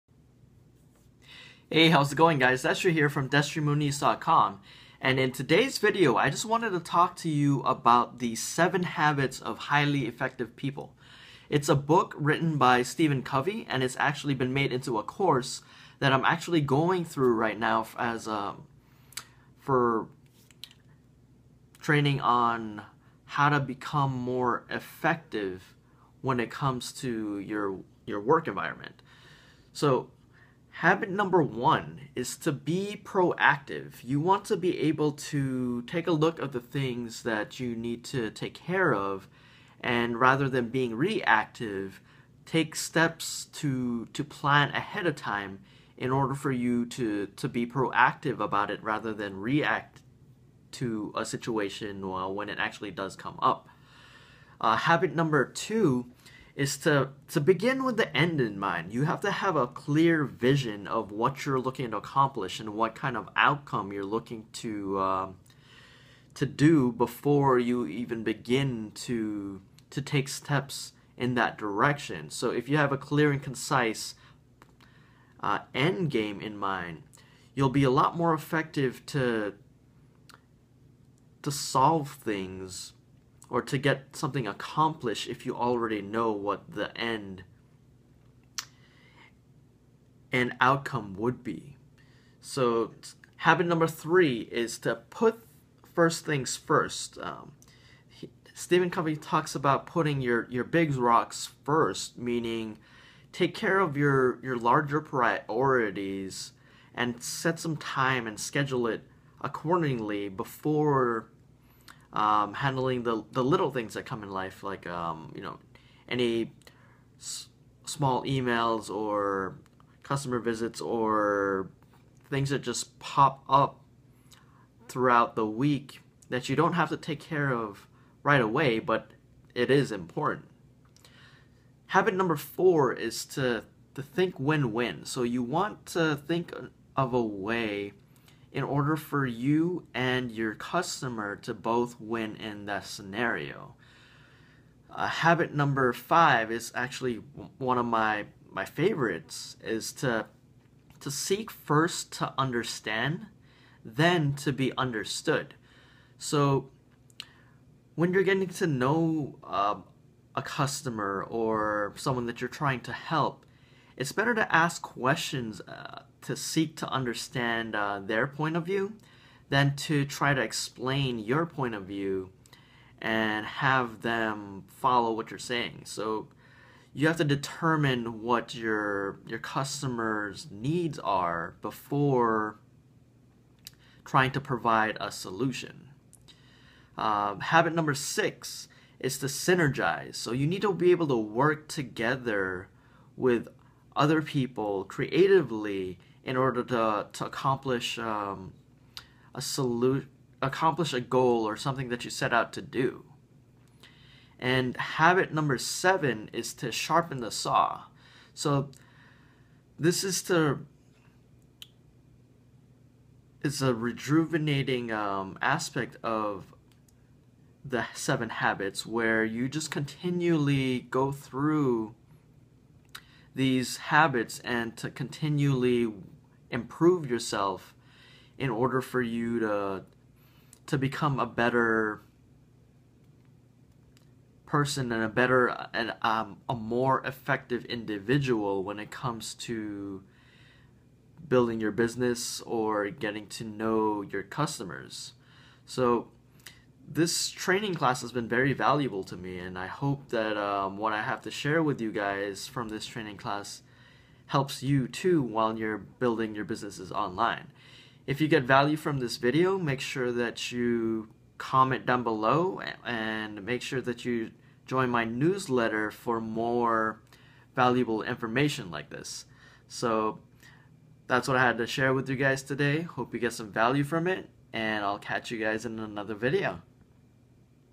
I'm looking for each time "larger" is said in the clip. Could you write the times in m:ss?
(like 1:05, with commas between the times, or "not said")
1:44.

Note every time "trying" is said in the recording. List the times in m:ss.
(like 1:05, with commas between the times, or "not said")
2:42, 3:04.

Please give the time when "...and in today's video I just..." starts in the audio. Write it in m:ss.
0:04.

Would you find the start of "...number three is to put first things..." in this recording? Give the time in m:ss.
1:33.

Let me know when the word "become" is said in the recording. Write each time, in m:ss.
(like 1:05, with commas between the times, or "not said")
0:23, 3:50.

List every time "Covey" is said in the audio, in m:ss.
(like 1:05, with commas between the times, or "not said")
0:13, 1:38.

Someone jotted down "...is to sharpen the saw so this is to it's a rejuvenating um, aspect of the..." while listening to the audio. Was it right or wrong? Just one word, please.
right.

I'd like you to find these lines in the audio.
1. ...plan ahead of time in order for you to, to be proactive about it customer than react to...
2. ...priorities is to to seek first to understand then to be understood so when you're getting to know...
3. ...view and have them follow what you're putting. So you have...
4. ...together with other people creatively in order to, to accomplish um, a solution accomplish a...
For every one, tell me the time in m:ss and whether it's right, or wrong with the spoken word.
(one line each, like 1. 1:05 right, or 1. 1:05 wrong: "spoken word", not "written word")
1. 0:44 wrong: "rather", not "customer"
2. 2:28 wrong: "favorites", not "priorities"
3. 2:51 wrong: "saying", not "putting"
4. 3:11 right.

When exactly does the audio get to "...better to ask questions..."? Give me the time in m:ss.
2:44.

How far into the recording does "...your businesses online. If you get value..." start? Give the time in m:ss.
4:16.